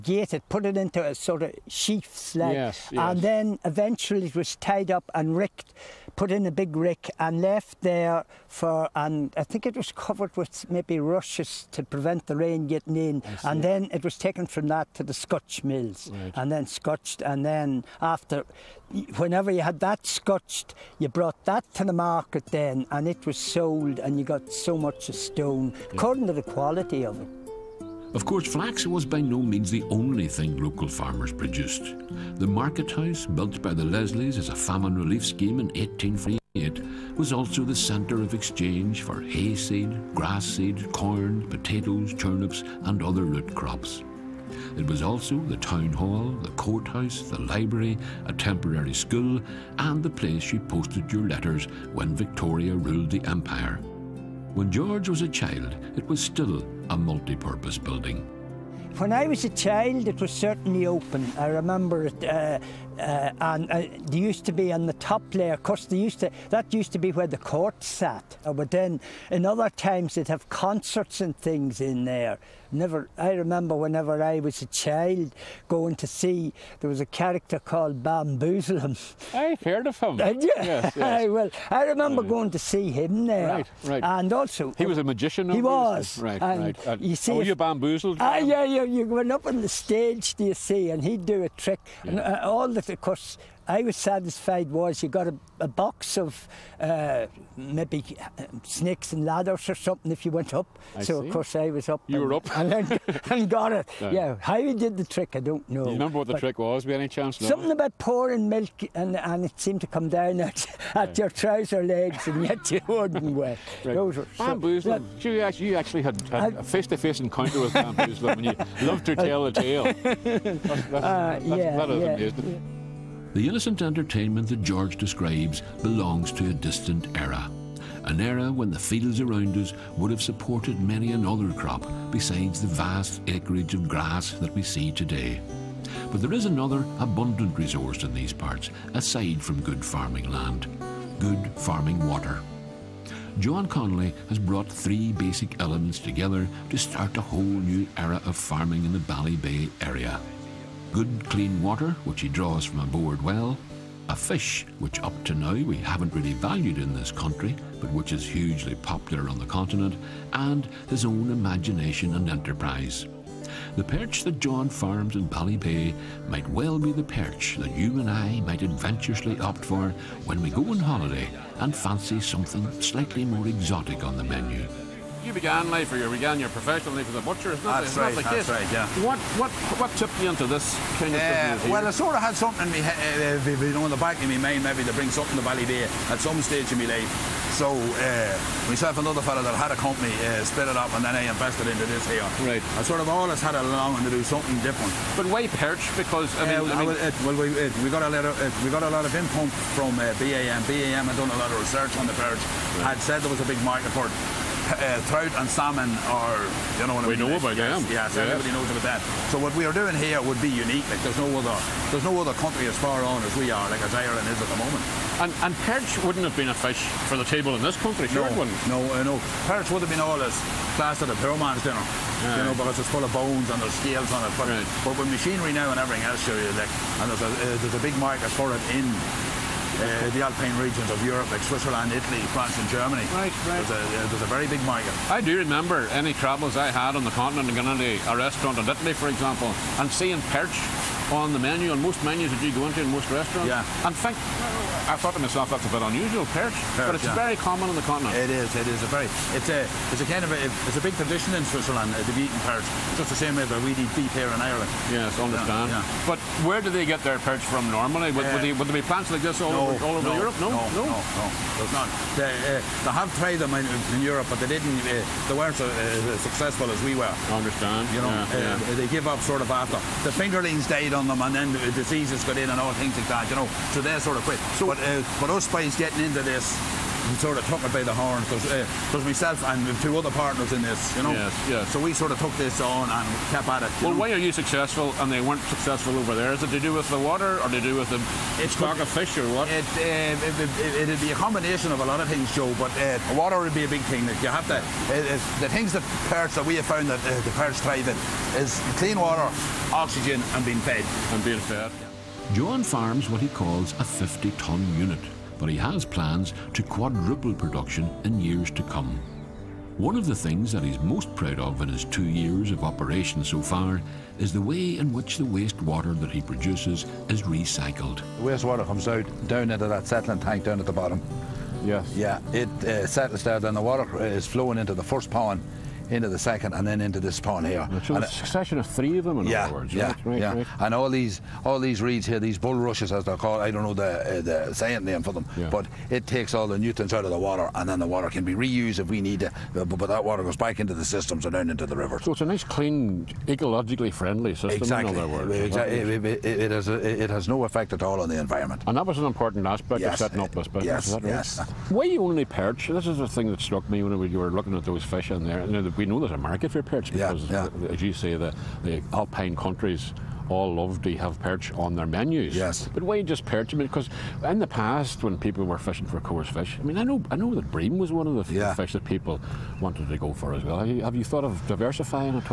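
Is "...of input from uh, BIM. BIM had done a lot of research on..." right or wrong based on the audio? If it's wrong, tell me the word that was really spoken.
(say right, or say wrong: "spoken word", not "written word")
right.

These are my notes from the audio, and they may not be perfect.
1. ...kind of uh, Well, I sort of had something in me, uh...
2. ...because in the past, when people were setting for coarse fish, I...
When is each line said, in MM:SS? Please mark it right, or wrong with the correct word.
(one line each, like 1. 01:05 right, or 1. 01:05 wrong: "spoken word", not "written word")
1. 03:01 right
2. 06:03 wrong: "fishing", not "setting".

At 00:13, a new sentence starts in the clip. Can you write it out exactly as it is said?
And then it was taken from that to the scotch mills right.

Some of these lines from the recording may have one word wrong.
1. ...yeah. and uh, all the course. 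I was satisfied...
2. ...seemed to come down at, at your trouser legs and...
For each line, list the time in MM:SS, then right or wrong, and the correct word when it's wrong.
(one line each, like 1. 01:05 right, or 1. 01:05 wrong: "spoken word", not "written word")
1. 01:32 right
2. 01:49 right.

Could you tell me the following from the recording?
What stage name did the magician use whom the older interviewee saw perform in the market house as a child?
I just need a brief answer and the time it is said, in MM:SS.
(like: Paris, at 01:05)
Bamboozle him, at 01:18.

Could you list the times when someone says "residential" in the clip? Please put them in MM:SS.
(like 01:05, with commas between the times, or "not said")
not said.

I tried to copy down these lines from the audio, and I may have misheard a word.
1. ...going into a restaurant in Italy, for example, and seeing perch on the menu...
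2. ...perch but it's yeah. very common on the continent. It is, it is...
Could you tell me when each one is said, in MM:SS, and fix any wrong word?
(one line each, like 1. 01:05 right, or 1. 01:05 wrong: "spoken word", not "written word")
1. 03:57 right
2. 04:06 right.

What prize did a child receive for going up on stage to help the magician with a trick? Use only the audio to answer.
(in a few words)
Snakes and ladders.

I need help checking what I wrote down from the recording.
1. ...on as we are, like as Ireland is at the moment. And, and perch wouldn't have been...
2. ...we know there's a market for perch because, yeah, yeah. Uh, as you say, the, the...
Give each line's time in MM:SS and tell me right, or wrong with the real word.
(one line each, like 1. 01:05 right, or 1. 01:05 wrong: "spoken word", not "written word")
1. 03:33 right
2. 05:55 right.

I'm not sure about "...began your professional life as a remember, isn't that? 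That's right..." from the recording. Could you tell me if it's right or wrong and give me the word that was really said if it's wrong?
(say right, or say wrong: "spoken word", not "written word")
wrong: "butcher", not "remember".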